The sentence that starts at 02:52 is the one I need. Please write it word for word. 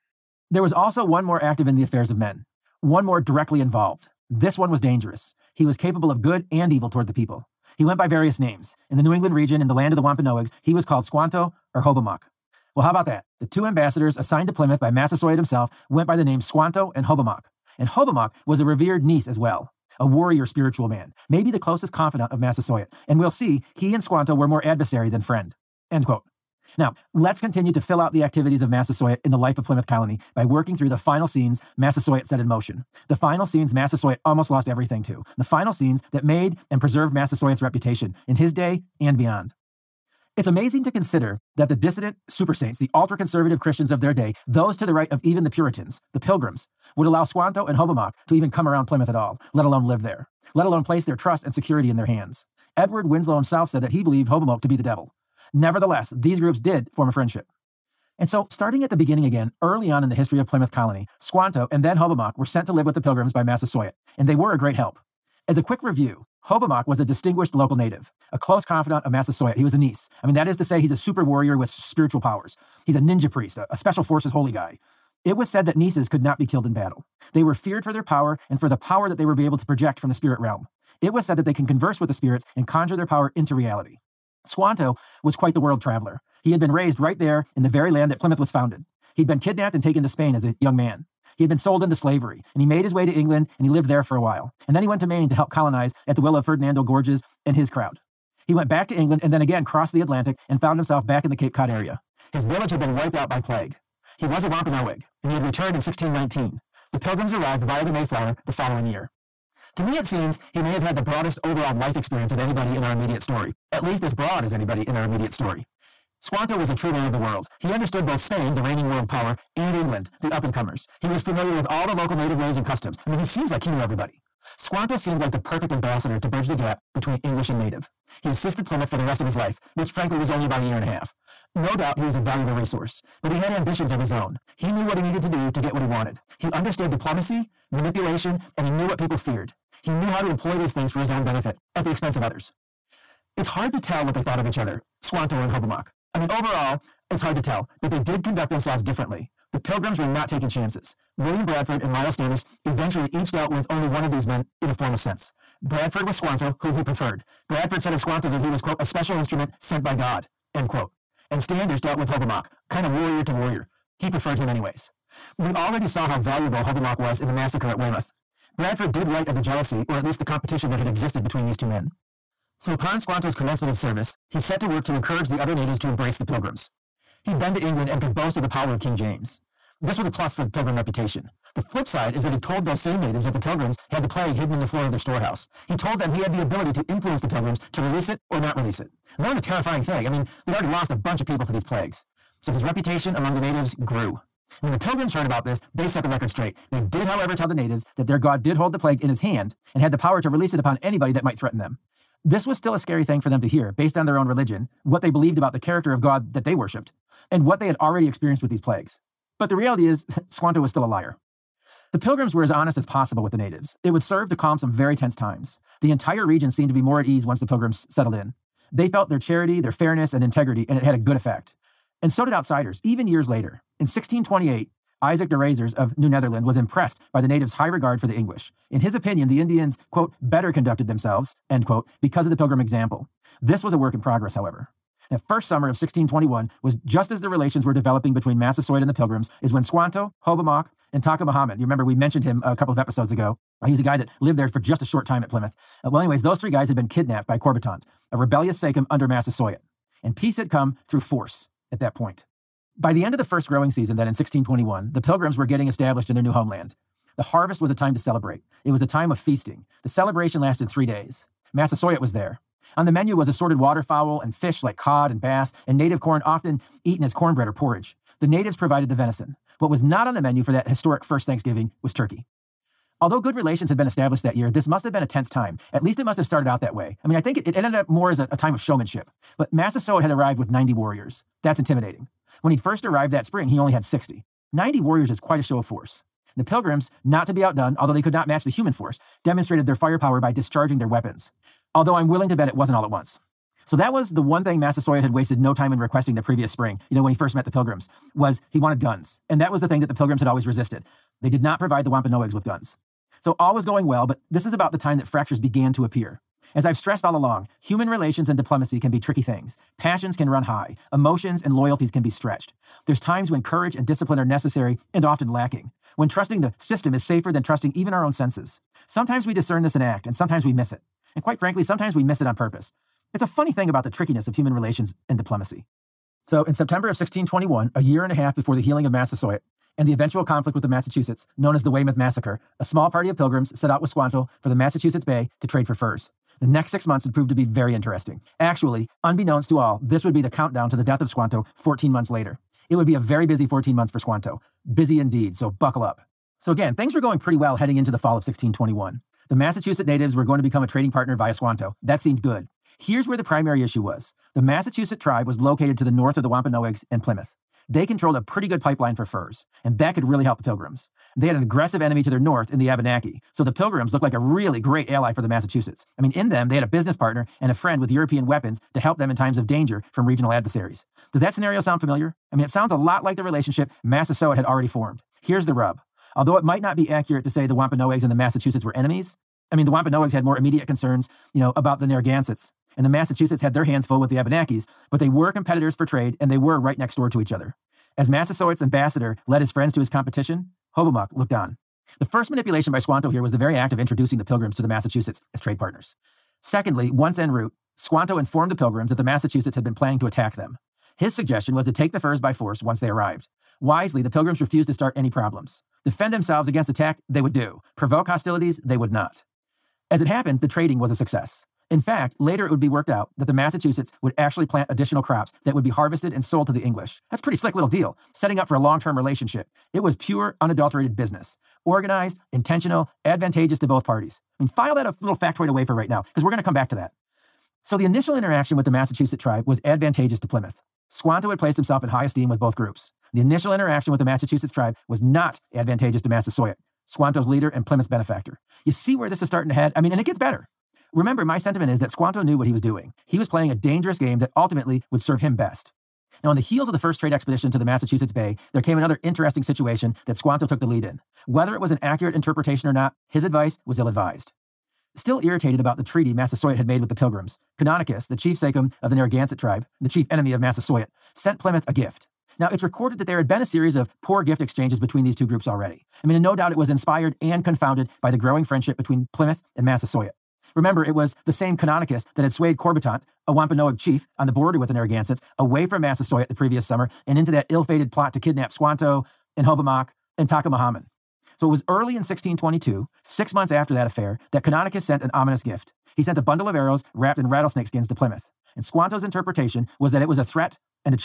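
So upon Squanto's commencement of service, he set to work to encourage the other natives to embrace the pilgrims.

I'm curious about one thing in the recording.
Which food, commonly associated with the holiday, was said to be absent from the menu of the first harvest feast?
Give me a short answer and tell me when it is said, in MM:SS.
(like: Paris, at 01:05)
Turkey, at 04:31.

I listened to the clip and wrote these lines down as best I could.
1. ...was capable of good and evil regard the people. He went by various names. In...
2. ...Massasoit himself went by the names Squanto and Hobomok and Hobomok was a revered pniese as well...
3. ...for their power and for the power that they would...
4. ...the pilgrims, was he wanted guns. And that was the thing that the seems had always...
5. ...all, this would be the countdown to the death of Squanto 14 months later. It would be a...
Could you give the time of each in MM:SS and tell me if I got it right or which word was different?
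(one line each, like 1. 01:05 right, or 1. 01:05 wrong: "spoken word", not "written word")
1. 00:05 wrong: "toward", not "regard"
2. 00:14 right
3. 01:17 right
4. 04:57 wrong: "pilgrims", not "seems"
5. 05:39 right.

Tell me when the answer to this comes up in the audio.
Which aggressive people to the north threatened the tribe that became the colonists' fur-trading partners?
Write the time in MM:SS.
06:02.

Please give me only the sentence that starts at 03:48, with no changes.
In his opinion, the Indians, quote, better conducted themselves, end quote, because of the pilgrim example.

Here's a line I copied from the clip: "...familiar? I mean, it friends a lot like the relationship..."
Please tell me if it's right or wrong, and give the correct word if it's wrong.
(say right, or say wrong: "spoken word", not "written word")
wrong: "sounds", not "friends".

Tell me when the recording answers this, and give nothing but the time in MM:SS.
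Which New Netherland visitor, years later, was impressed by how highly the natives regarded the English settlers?
03:45.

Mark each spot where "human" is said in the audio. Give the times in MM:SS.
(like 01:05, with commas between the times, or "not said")
04:48, 05:07, 05:24.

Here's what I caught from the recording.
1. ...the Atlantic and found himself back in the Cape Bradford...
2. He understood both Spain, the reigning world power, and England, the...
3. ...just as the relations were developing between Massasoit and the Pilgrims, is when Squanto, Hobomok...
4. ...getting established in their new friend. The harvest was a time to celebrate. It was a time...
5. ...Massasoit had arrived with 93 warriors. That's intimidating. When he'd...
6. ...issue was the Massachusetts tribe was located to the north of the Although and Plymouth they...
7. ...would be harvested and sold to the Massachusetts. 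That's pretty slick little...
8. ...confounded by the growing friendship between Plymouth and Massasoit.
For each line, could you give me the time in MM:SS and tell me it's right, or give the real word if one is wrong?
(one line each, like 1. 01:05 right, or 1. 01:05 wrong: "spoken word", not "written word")
1. 01:39 wrong: "Cod", not "Bradford"
2. 01:57 right
3. 03:56 right
4. 04:15 wrong: "homeland", not "friend"
5. 04:39 wrong: "90", not "93"
6. 05:53 wrong: "Wampanoags", not "Although"
7. 06:55 wrong: "English", not "Massachusetts"
8. 07:47 right.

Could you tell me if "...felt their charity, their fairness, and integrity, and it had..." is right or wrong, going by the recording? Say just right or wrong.
right.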